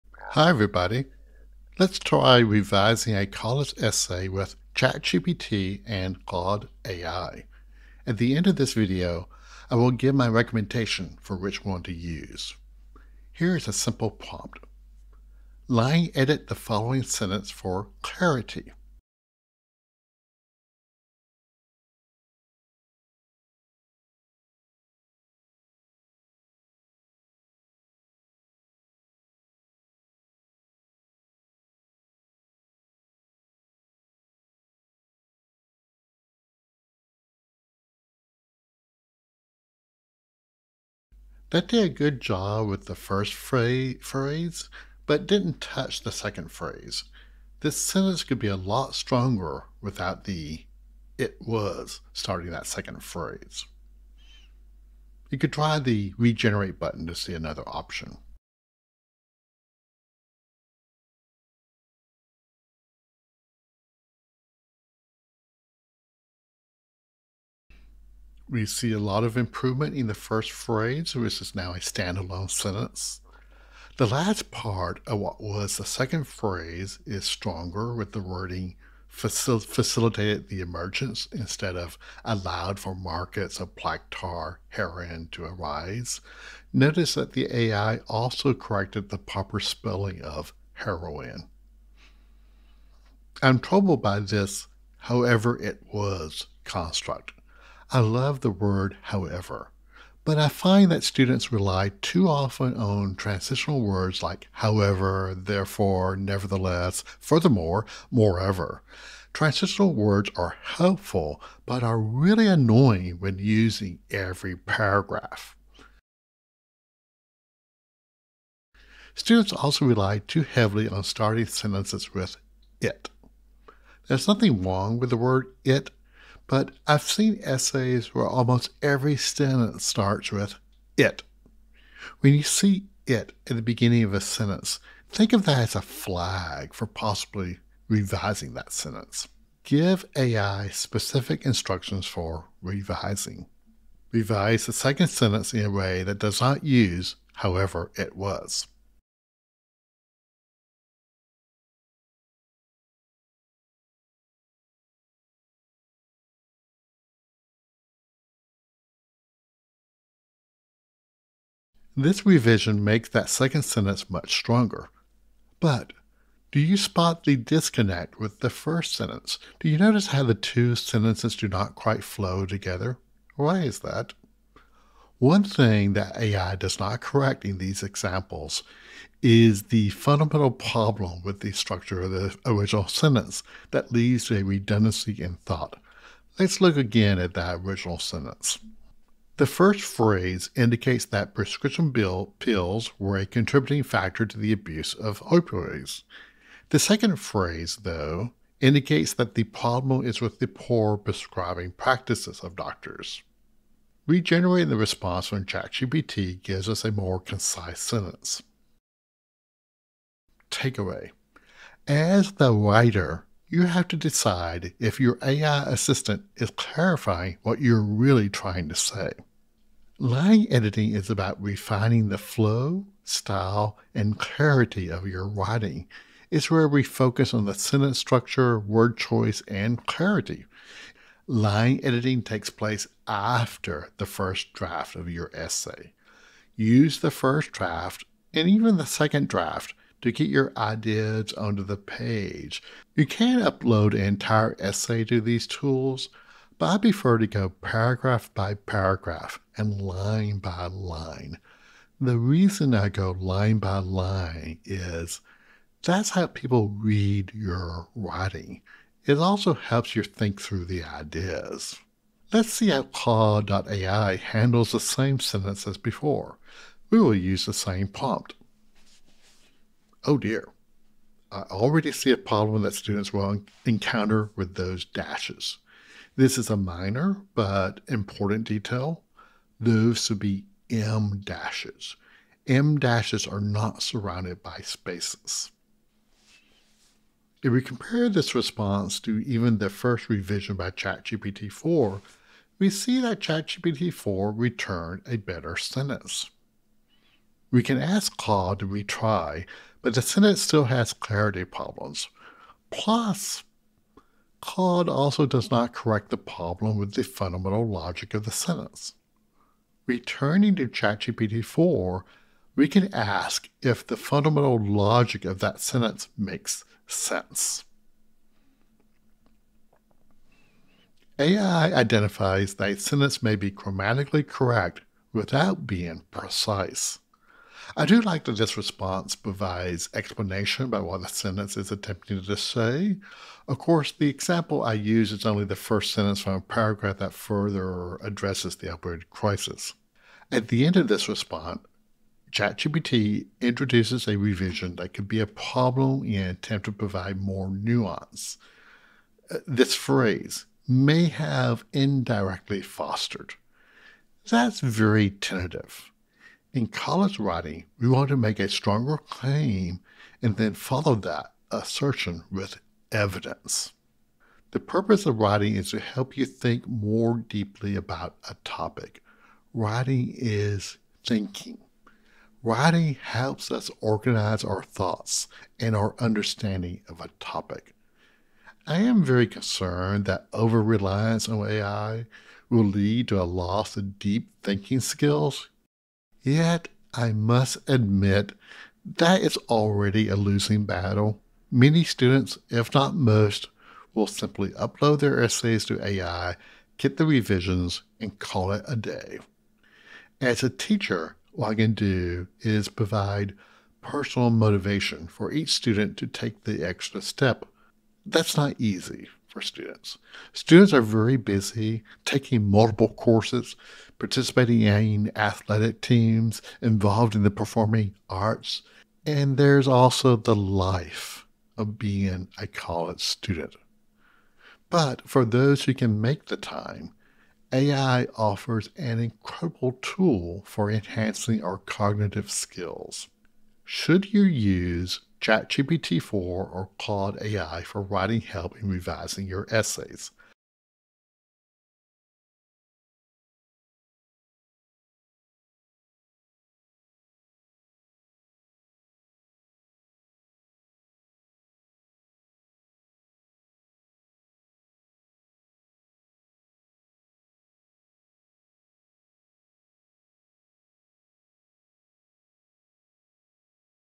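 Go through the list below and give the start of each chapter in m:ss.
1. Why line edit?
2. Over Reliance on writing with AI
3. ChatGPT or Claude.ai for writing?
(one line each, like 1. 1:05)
1. 3:40
2. 6:18
3. 7:14.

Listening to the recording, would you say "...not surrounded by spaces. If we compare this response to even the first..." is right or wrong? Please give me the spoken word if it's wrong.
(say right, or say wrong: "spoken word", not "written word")
right.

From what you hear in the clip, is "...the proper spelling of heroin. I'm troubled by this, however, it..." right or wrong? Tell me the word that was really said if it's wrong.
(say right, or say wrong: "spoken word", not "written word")
right.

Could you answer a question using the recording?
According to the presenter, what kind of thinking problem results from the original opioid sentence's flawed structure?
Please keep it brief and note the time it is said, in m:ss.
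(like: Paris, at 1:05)
redundancy, at 3:04.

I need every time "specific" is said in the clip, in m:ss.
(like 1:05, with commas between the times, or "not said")
2:20.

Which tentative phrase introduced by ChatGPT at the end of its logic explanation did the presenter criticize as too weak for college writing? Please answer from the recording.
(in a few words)
may have indirectly fostered.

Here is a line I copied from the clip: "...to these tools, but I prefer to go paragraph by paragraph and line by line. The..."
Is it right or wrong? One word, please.
right.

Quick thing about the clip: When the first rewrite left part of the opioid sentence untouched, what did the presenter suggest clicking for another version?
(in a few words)
regenerate button.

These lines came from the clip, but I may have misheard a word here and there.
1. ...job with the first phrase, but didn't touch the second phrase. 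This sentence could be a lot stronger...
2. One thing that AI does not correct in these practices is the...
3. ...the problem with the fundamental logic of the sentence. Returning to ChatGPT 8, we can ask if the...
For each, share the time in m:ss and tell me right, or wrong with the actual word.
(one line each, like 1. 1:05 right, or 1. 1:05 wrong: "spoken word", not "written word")
1. 0:42 right
2. 2:55 wrong: "examples", not "practices"
3. 5:06 wrong: "4", not "8".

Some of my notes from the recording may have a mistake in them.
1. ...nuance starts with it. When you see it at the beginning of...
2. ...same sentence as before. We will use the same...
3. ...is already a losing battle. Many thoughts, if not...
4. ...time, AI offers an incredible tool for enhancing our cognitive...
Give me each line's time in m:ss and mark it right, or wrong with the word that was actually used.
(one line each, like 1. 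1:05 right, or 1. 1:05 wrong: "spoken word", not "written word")
1. 2:09 wrong: "sentence", not "nuance"
2. 4:24 right
3. 6:29 wrong: "students", not "thoughts"
4. 7:06 right.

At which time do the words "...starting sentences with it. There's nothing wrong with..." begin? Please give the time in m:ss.
2:01.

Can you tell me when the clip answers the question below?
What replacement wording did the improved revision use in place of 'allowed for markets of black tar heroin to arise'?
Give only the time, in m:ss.
1:19.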